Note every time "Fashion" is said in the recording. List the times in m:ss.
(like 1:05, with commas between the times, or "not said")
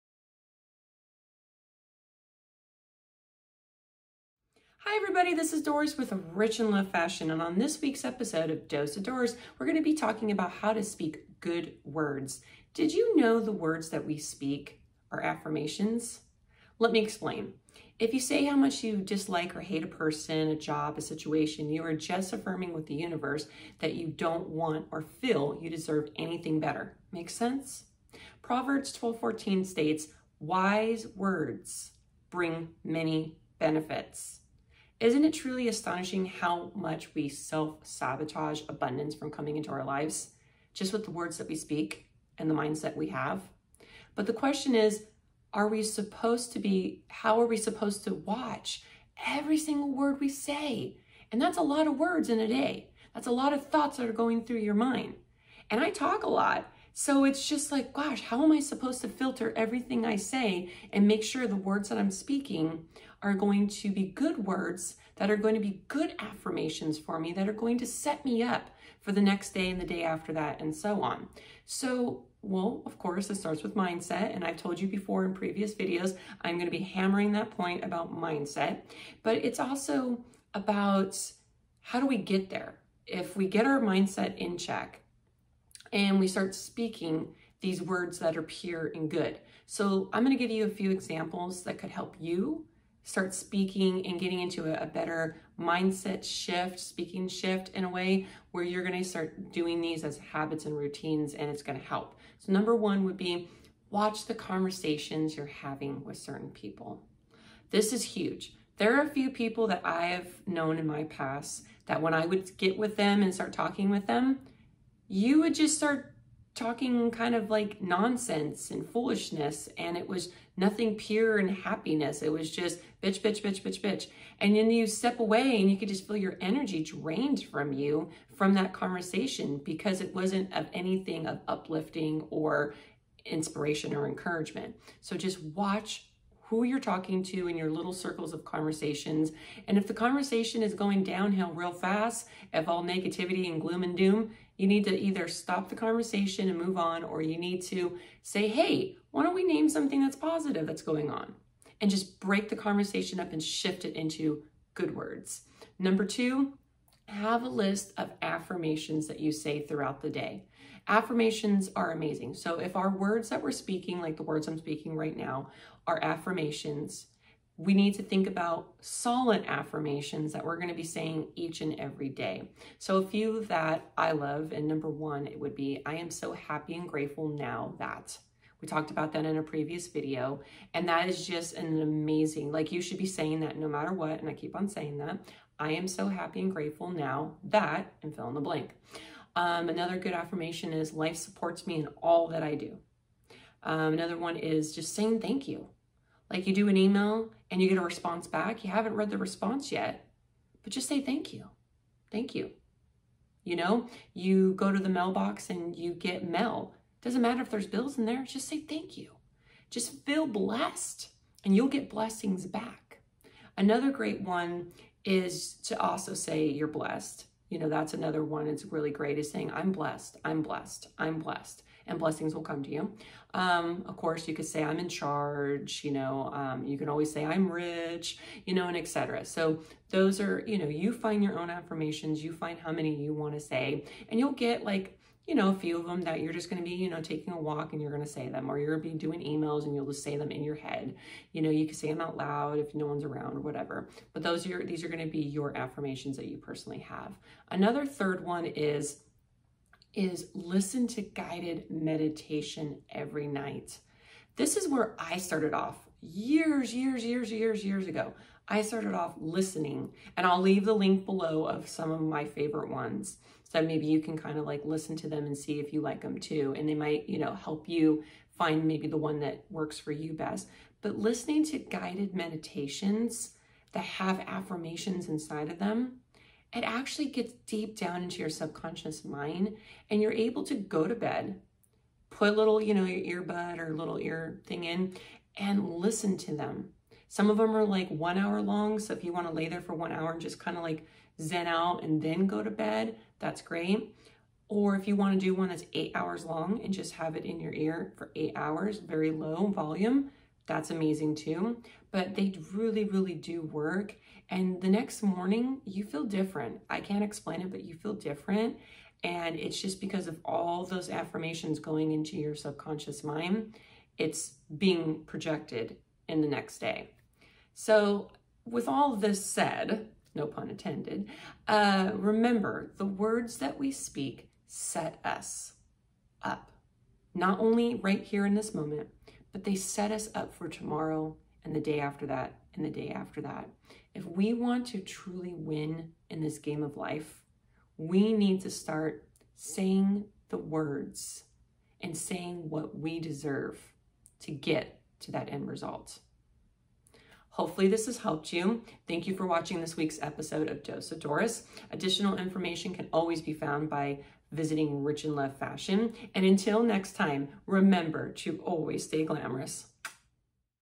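0:06, 5:55.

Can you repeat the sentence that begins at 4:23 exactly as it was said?
So maybe you can kind of like listen to them and see if you like them too.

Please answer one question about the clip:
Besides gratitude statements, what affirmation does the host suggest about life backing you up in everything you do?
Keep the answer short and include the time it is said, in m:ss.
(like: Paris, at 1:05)
Life supports me in all that I do, at 3:10.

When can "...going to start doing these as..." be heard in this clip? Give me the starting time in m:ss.
1:38.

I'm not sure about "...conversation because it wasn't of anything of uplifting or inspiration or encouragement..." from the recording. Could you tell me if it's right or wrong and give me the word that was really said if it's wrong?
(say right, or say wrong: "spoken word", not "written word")
right.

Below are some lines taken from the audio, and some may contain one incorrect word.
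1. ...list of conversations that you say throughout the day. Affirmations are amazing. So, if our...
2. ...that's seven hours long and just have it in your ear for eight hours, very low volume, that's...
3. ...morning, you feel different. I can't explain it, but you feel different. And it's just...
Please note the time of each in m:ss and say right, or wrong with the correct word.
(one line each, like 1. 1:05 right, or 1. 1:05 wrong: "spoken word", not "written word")
1. 2:37 wrong: "affirmations", not "conversations"
2. 4:55 wrong: "eight", not "seven"
3. 5:05 right.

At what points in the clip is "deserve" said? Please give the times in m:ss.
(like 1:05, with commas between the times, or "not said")
0:25, 5:42.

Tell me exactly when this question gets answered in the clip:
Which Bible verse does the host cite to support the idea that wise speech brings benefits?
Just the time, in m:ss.
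0:28.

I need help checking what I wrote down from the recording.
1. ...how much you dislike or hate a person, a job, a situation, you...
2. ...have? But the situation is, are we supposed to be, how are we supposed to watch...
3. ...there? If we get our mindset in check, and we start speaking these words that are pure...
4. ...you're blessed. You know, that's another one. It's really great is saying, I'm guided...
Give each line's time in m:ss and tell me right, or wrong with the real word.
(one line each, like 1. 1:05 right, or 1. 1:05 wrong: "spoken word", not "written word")
1. 0:18 right
2. 0:43 wrong: "question", not "situation"
3. 1:22 right
4. 3:36 wrong: "blessed", not "guided".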